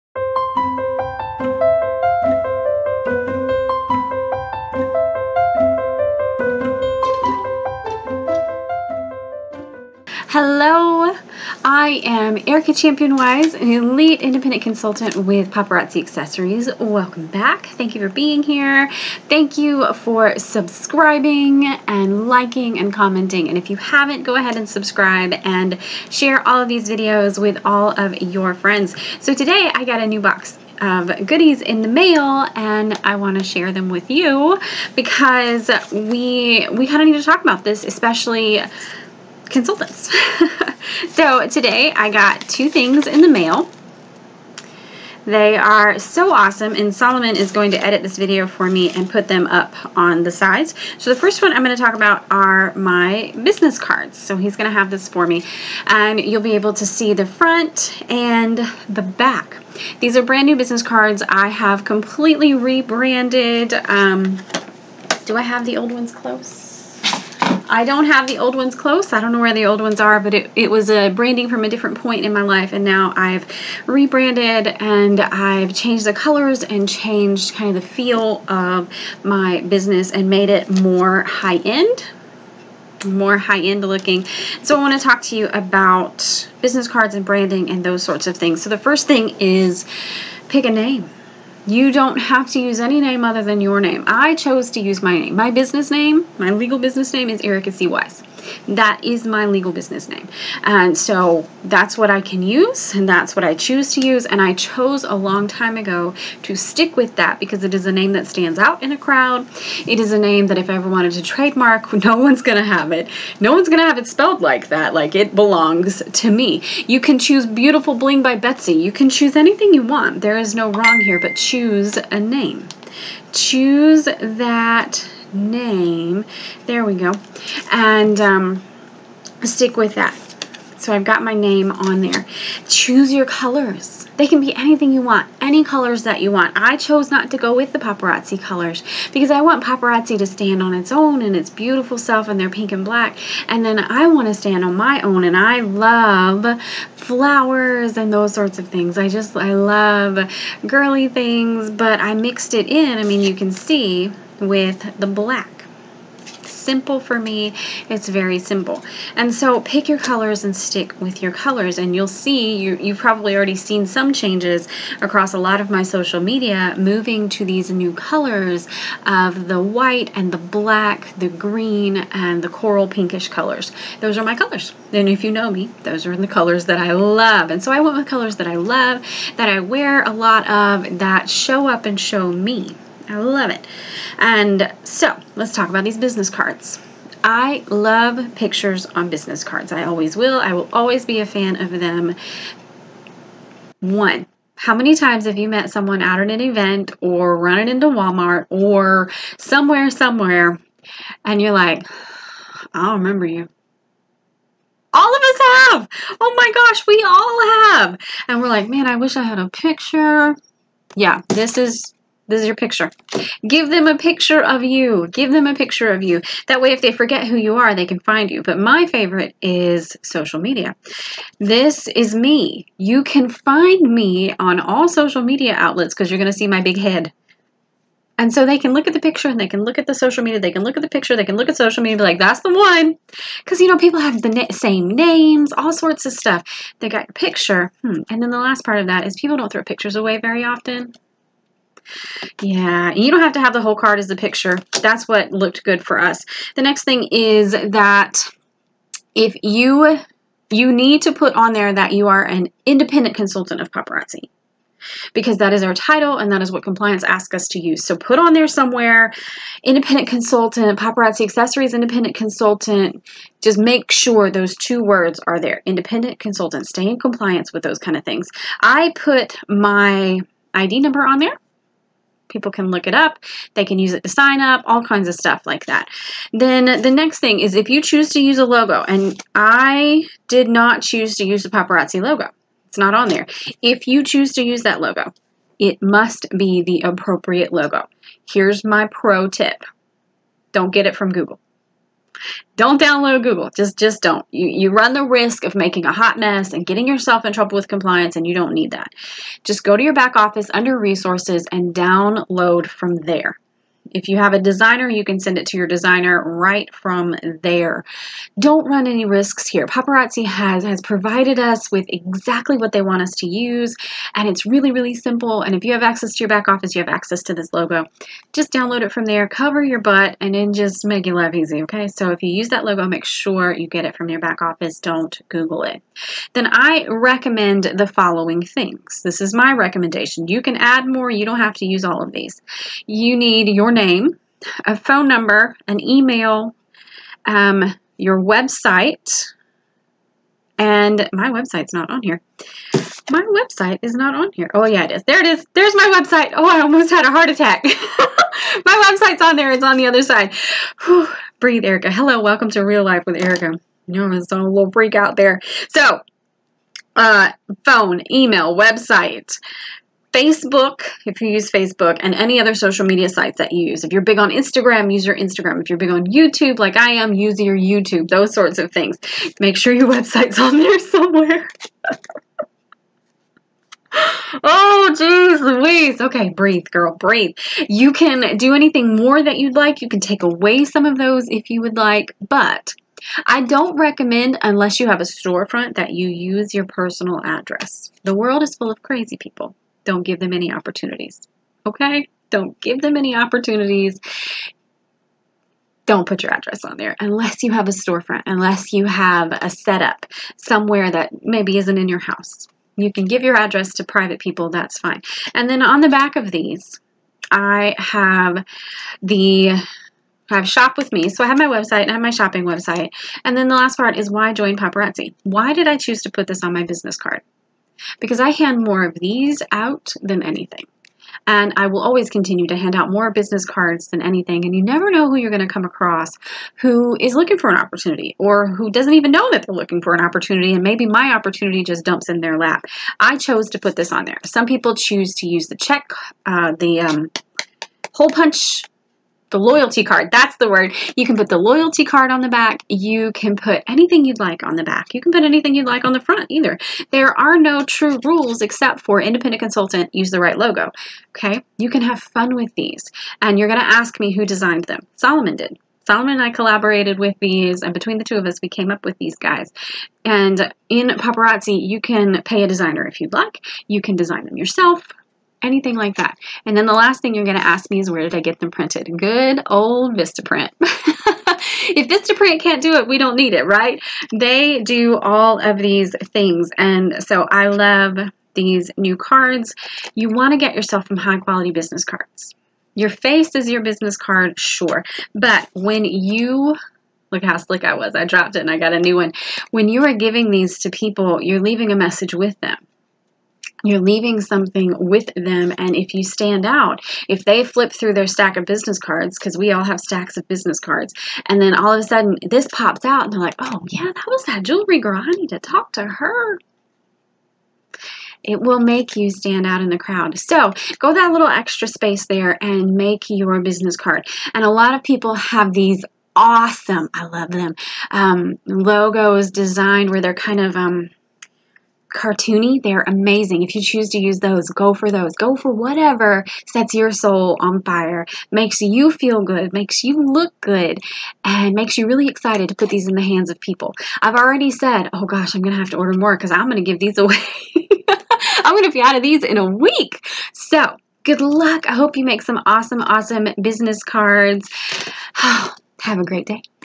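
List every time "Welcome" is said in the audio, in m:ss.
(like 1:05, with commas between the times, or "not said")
0:16, 5:52.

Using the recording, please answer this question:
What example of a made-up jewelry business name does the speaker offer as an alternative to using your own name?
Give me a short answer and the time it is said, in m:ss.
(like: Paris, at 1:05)
Beautiful Bling by Betsy, at 1:57.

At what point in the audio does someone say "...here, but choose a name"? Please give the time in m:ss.
2:01.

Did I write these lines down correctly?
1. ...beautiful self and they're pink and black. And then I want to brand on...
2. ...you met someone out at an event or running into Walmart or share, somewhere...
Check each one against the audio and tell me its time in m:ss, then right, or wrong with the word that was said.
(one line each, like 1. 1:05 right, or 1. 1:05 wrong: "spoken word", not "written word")
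1. 2:21 wrong: "stand", not "brand"
2. 3:15 wrong: "somewhere", not "share".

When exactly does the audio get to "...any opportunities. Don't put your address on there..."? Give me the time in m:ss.
6:32.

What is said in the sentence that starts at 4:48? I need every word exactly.
Here's my pro tip don't get it from Google don't download Google.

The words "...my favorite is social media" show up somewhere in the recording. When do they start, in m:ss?
3:38.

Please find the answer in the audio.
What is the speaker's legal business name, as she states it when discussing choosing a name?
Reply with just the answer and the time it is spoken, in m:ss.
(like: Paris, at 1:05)
Ericka C. Wise, at 1:37.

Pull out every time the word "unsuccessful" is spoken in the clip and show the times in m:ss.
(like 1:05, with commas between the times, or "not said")
not said.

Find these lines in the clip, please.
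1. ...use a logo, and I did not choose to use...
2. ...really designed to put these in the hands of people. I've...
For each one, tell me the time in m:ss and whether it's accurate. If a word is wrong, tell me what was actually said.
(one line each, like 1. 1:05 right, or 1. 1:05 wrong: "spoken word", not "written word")
1. 4:38 right
2. 8:51 wrong: "excited", not "designed".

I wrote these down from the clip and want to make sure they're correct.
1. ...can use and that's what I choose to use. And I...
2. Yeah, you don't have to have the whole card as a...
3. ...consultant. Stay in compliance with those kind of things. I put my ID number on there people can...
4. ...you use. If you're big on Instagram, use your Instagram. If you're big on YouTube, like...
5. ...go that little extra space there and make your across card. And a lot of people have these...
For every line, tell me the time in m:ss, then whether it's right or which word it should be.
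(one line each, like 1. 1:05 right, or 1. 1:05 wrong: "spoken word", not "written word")
1. 1:42 right
2. 4:02 right
3. 4:26 right
4. 6:03 right
5. 8:30 wrong: "business", not "across".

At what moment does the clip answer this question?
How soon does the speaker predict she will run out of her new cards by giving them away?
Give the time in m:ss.
8:59.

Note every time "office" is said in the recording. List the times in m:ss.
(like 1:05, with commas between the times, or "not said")
5:00, 5:16, 5:24.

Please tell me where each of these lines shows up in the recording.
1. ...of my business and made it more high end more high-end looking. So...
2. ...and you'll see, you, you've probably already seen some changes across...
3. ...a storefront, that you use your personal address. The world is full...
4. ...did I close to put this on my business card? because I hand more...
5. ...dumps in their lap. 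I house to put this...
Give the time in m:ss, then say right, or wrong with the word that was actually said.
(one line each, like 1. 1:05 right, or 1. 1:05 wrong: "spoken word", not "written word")
1. 1:18 right
2. 2:41 right
3. 6:25 right
4. 6:55 wrong: "choose", not "close"
5. 7:11 wrong: "chose", not "house".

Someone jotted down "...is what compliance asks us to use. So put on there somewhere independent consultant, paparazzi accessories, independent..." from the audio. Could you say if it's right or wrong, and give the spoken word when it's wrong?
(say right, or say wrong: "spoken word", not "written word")
right.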